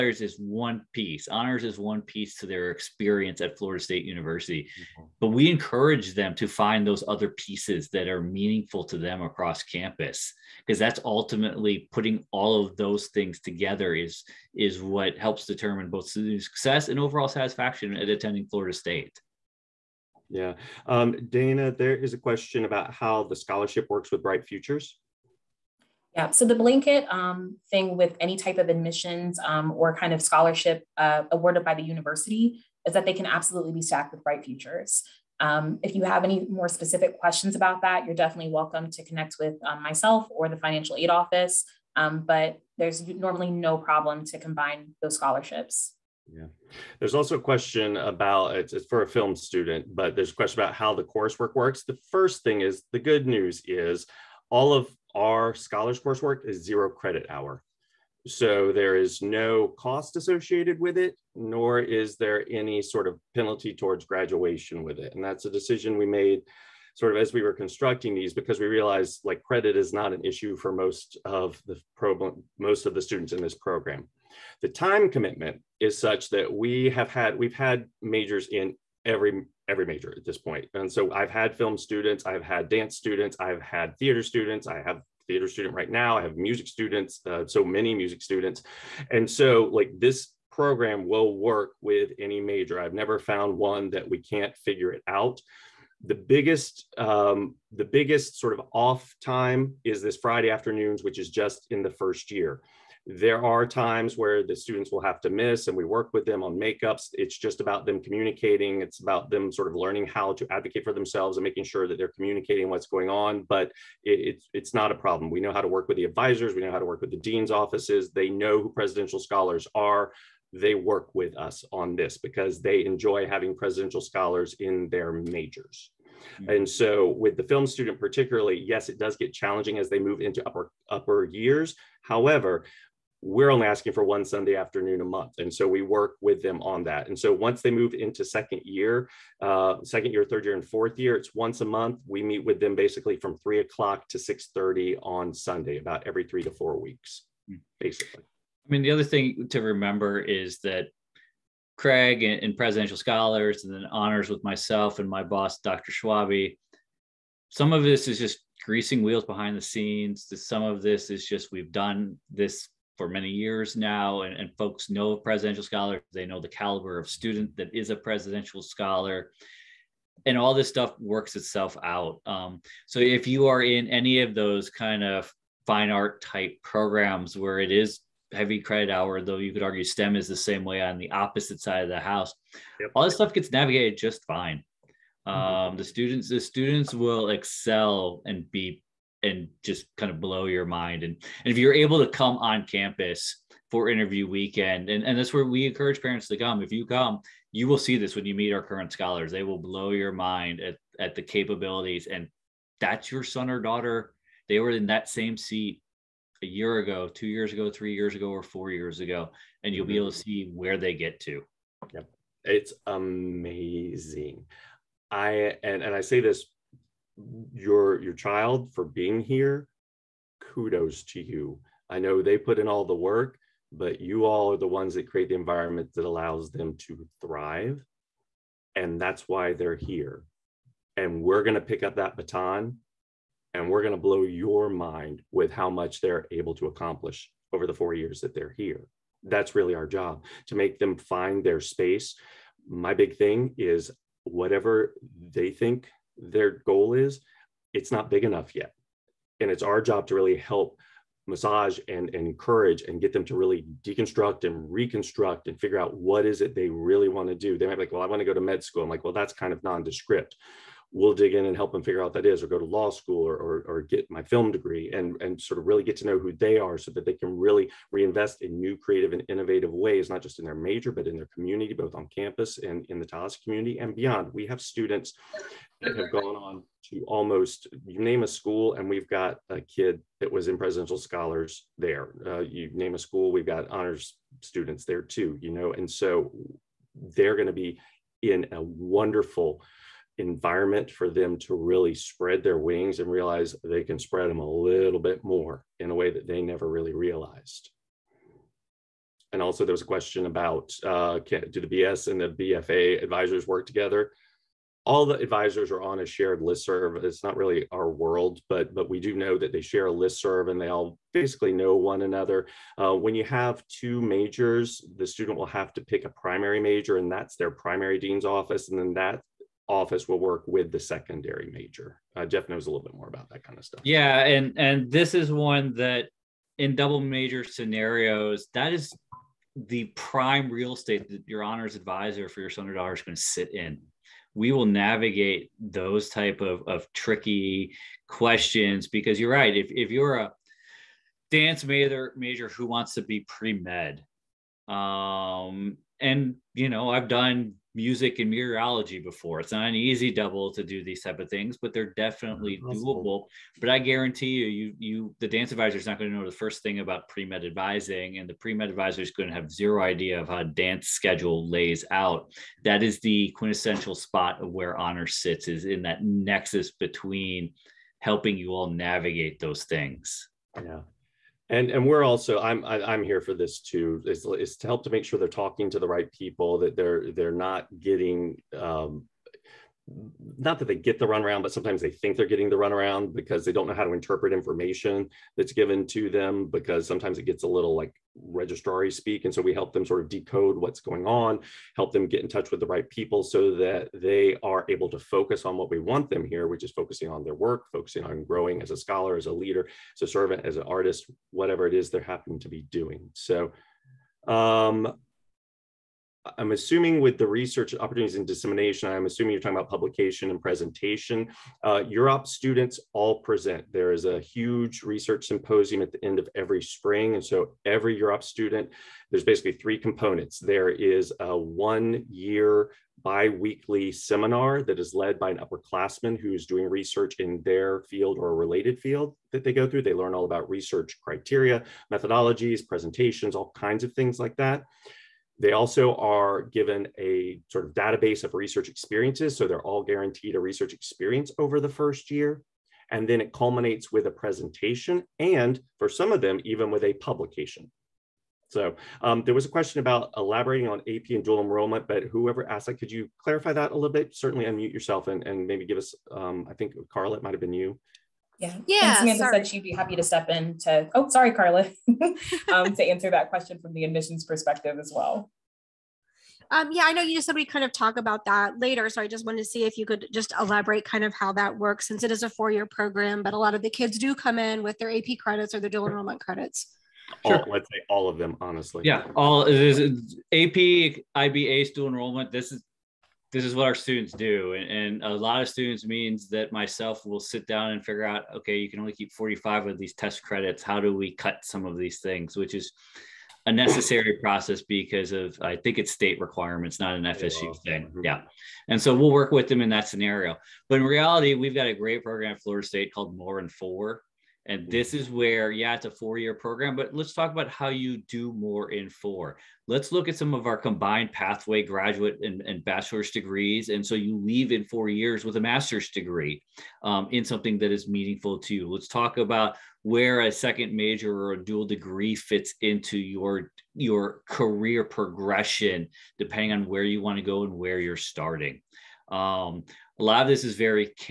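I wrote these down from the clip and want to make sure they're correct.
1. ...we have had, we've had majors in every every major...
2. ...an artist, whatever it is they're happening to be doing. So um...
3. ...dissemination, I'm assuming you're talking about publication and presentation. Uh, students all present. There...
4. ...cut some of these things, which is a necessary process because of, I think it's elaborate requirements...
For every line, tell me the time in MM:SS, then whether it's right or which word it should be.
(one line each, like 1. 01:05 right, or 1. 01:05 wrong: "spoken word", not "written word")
1. 01:16 right
2. 06:40 right
3. 06:48 right
4. 08:11 wrong: "state", not "elaborate".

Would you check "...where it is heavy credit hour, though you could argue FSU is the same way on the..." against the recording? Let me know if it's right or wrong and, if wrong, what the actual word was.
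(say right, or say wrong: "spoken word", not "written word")
wrong: "STEM", not "FSU".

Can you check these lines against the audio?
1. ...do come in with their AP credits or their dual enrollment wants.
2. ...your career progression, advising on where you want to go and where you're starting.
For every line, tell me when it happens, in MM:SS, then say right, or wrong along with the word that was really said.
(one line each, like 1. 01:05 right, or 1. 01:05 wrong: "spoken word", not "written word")
1. 07:53 wrong: "credits", not "wants"
2. 08:43 wrong: "depending", not "advising".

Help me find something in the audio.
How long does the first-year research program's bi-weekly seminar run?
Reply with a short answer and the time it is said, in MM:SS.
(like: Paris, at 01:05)
1 year, at 07:01.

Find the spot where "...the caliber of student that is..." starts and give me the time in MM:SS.
02:46.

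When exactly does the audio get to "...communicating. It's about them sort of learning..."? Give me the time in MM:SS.
01:47.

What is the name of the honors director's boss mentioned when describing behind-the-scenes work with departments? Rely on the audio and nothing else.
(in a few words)
Dr. Schwabe.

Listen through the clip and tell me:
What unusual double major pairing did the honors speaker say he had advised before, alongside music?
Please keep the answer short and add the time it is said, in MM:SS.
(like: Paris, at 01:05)
Meteorology, at 05:48.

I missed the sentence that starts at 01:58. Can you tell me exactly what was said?
They know who presidential scholars are they work with us on this because they enjoy having presidential scholars in their majors.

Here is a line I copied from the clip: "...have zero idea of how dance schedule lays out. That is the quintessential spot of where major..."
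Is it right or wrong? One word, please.
wrong.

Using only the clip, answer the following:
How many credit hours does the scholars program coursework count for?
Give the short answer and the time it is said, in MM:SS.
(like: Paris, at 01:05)
0, at 00:56.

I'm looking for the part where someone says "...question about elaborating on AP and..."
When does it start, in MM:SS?
07:29.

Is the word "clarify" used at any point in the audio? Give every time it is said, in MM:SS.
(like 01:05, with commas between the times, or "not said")
07:33.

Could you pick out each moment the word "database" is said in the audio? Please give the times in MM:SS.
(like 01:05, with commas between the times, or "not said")
07:17.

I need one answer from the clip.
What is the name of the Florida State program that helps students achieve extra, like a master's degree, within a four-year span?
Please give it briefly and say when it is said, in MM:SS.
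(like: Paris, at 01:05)
More in Four, at 08:23.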